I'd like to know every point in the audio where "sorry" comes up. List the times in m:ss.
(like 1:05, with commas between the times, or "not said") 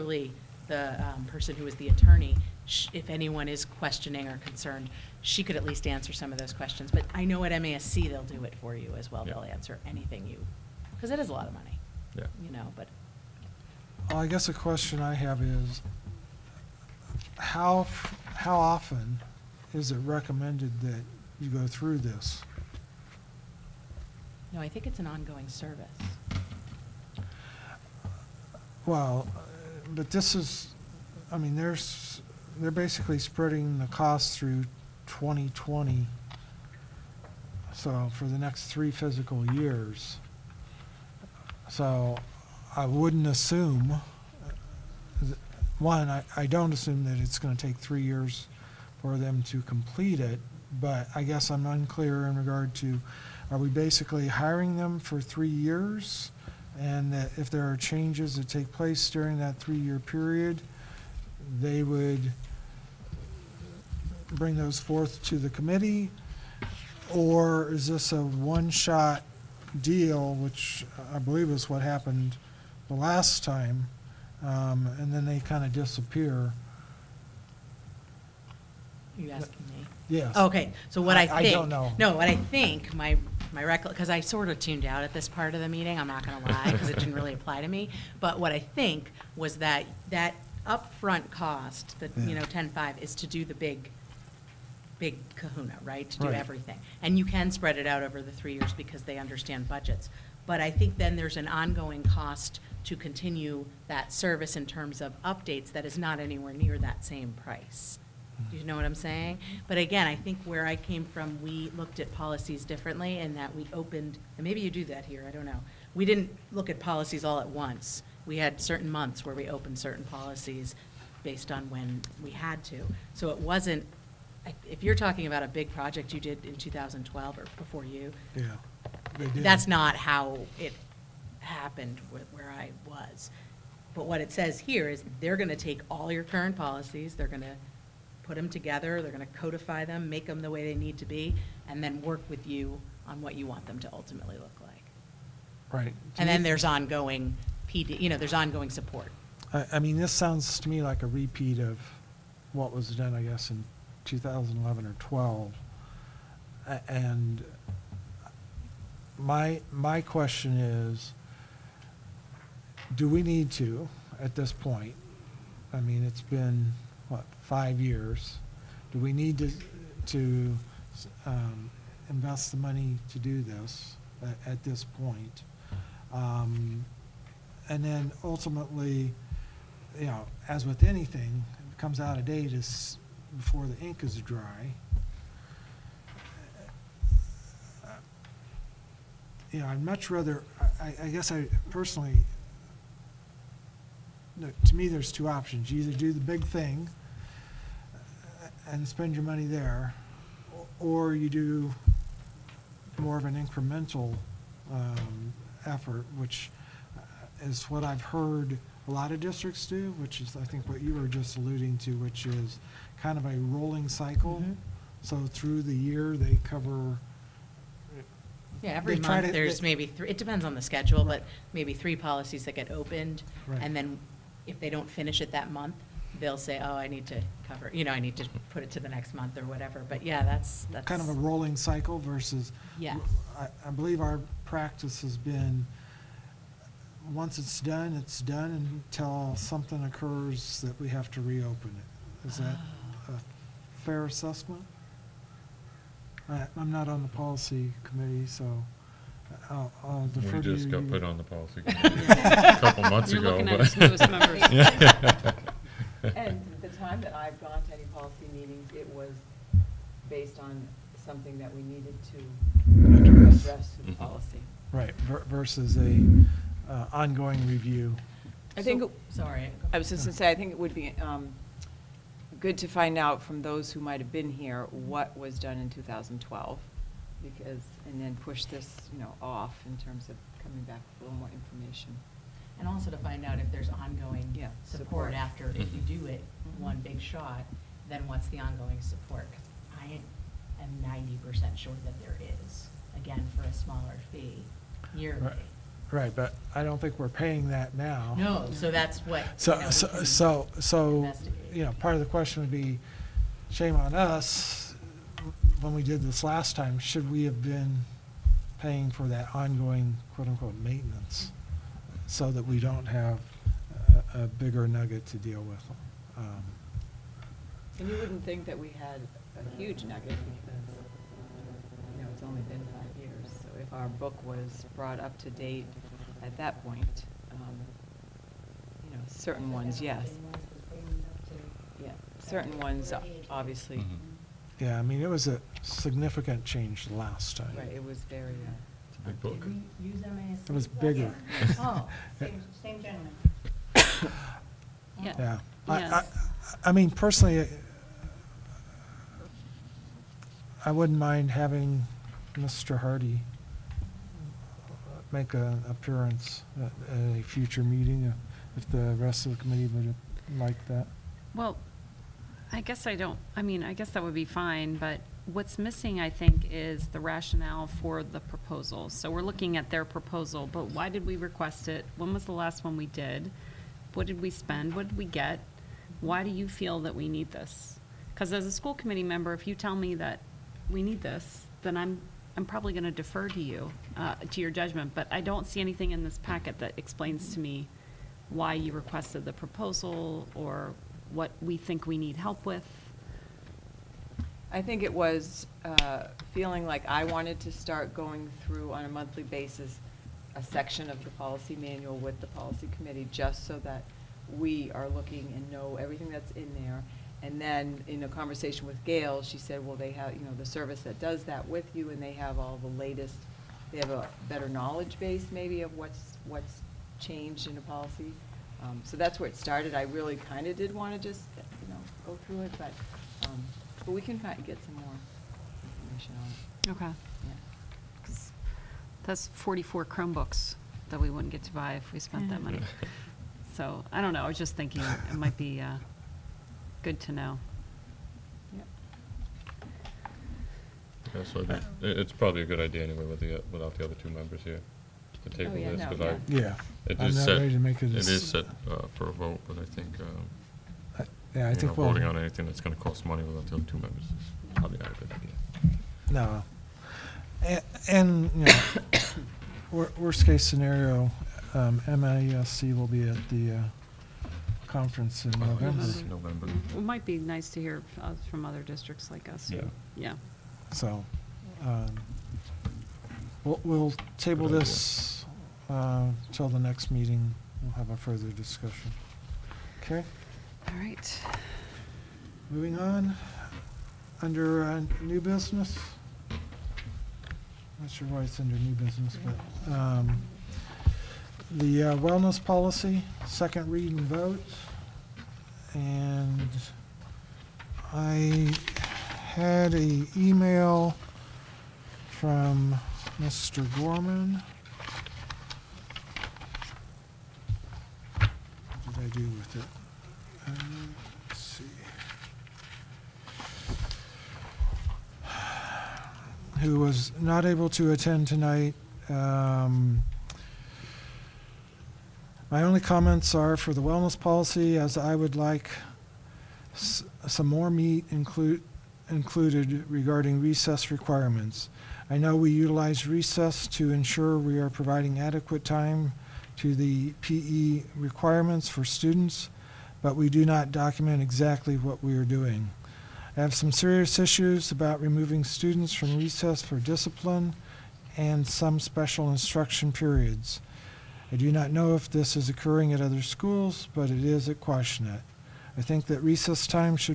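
4:29.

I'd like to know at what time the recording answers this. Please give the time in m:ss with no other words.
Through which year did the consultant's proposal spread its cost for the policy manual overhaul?
0:35.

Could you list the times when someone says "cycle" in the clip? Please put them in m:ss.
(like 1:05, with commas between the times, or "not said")
3:33, 3:51.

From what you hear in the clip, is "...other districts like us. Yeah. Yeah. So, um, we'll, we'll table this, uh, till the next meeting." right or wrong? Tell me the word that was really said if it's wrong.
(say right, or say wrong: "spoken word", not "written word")
right.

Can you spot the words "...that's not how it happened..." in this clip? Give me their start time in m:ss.
2:09.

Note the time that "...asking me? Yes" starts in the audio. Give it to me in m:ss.
1:19.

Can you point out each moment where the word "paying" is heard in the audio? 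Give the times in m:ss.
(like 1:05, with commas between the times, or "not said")
4:57, 5:08.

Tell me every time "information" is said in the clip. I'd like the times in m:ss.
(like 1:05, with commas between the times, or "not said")
4:41, 7:05.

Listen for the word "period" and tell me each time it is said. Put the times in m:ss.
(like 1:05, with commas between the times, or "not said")
0:59, 9:09.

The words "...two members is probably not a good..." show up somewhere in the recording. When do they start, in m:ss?
7:33.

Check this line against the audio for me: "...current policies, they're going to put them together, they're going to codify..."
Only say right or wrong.
right.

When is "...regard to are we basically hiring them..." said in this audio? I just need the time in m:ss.
0:52.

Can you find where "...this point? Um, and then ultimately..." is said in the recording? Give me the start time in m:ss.
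2:54.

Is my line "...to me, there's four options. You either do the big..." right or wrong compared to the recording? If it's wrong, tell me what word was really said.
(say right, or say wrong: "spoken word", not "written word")
wrong: "two", not "four".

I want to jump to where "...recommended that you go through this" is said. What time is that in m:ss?
0:19.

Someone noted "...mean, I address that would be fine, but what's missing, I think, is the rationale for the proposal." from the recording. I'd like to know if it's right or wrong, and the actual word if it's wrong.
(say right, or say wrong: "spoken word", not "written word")
wrong: "guess", not "address".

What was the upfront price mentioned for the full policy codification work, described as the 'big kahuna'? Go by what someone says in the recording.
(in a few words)
ten-five.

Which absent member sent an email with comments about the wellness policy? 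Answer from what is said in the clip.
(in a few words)
Mr. Gorman.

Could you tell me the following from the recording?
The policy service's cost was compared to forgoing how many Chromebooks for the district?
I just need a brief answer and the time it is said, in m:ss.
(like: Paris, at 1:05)
44, at 7:09.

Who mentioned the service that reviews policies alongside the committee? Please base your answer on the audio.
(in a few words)
Gail.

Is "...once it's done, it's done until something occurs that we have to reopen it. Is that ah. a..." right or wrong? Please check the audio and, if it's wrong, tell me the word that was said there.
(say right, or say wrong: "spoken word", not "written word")
right.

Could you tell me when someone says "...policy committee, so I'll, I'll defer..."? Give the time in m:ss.
4:07.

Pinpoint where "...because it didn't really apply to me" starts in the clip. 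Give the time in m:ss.
1:26.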